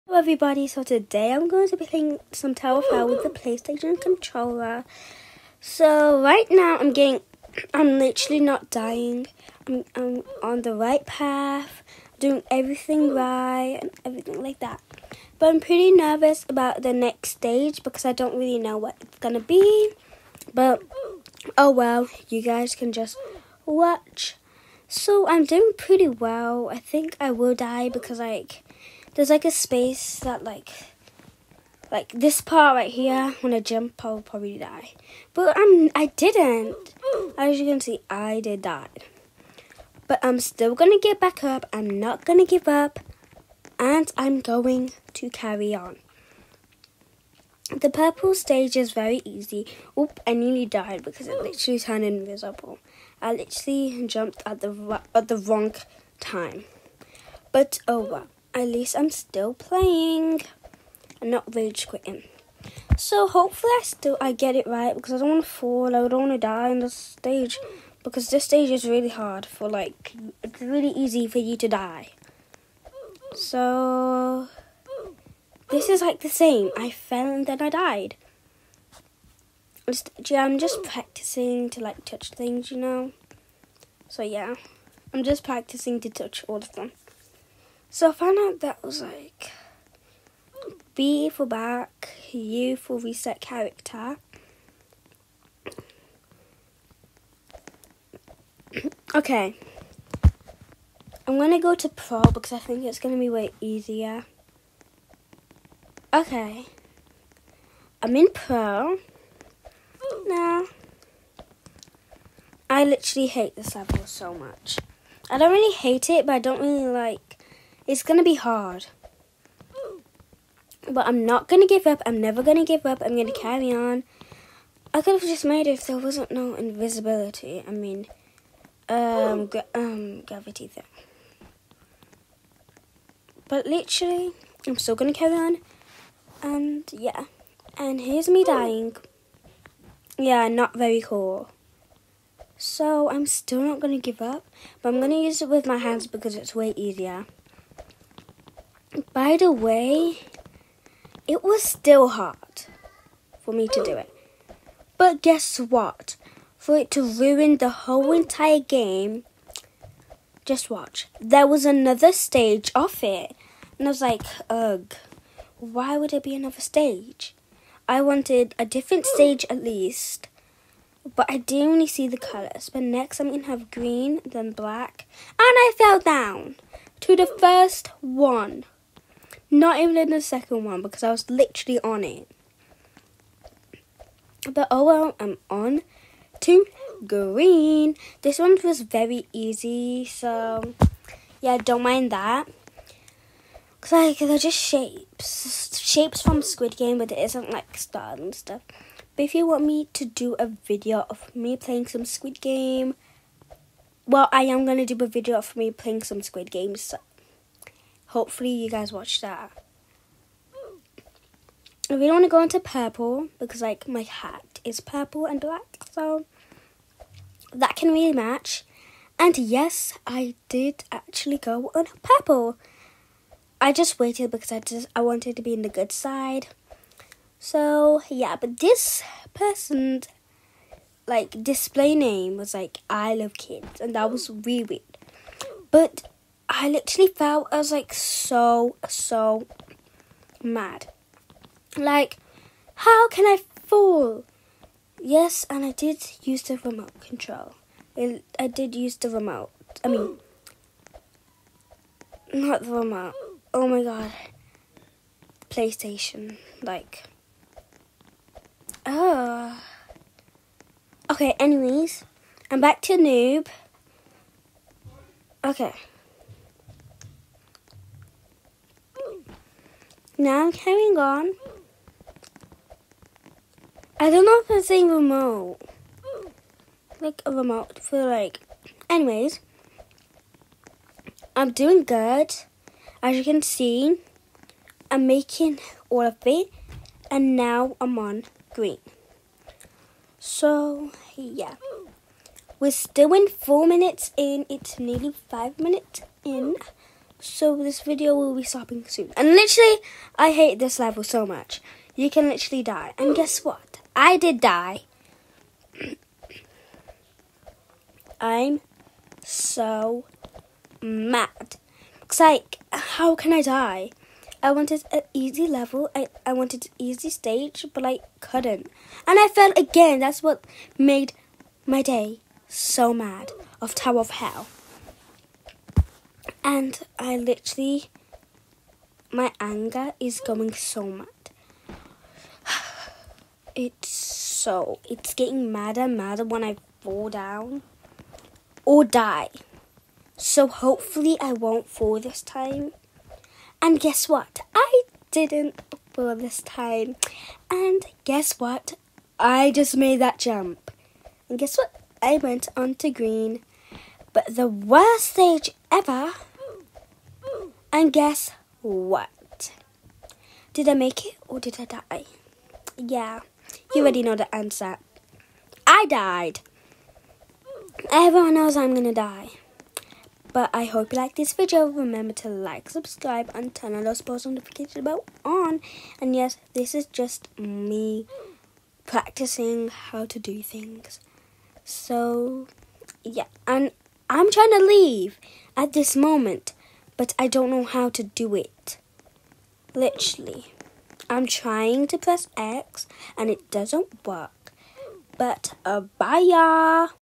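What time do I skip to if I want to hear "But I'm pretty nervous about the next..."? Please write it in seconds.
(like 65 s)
15 s.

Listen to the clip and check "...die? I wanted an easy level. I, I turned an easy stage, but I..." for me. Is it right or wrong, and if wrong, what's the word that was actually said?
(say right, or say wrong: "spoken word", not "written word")
wrong: "wanted", not "turned".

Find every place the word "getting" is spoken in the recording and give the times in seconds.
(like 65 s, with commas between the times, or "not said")
6 s, 335 s.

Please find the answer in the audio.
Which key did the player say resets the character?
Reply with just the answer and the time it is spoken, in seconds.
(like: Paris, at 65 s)
U, at 92 s.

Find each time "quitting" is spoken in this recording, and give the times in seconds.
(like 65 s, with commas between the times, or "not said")
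61 s.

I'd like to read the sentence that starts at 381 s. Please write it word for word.
So, yeah, and I'm trying to leave at this moment but I don't know how to do it.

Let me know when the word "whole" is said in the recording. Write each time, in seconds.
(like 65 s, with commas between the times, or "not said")
157 s.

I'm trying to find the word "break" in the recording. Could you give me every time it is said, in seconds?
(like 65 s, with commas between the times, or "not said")
not said.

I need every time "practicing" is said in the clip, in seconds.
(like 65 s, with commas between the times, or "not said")
80 s, 85 s, 378 s.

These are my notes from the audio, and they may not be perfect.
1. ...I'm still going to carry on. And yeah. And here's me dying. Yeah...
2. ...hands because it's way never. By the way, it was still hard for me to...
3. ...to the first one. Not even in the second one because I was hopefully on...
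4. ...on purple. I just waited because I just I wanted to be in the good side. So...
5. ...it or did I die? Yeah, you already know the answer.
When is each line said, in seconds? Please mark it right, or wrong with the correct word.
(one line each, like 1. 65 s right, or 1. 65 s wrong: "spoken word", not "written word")
1. 134 s right
2. 145 s wrong: "easier", not "never"
3. 177 s wrong: "literally", not "hopefully"
4. 221 s right
5. 361 s right.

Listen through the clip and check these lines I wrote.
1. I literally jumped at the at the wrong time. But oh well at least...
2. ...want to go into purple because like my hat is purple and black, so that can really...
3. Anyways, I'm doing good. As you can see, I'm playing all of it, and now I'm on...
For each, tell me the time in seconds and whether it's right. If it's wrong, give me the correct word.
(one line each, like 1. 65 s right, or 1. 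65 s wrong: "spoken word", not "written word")
1. 53 s right
2. 212 s right
3. 278 s wrong: "making", not "playing".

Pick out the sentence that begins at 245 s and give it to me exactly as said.
Yes, and I did use the remote control.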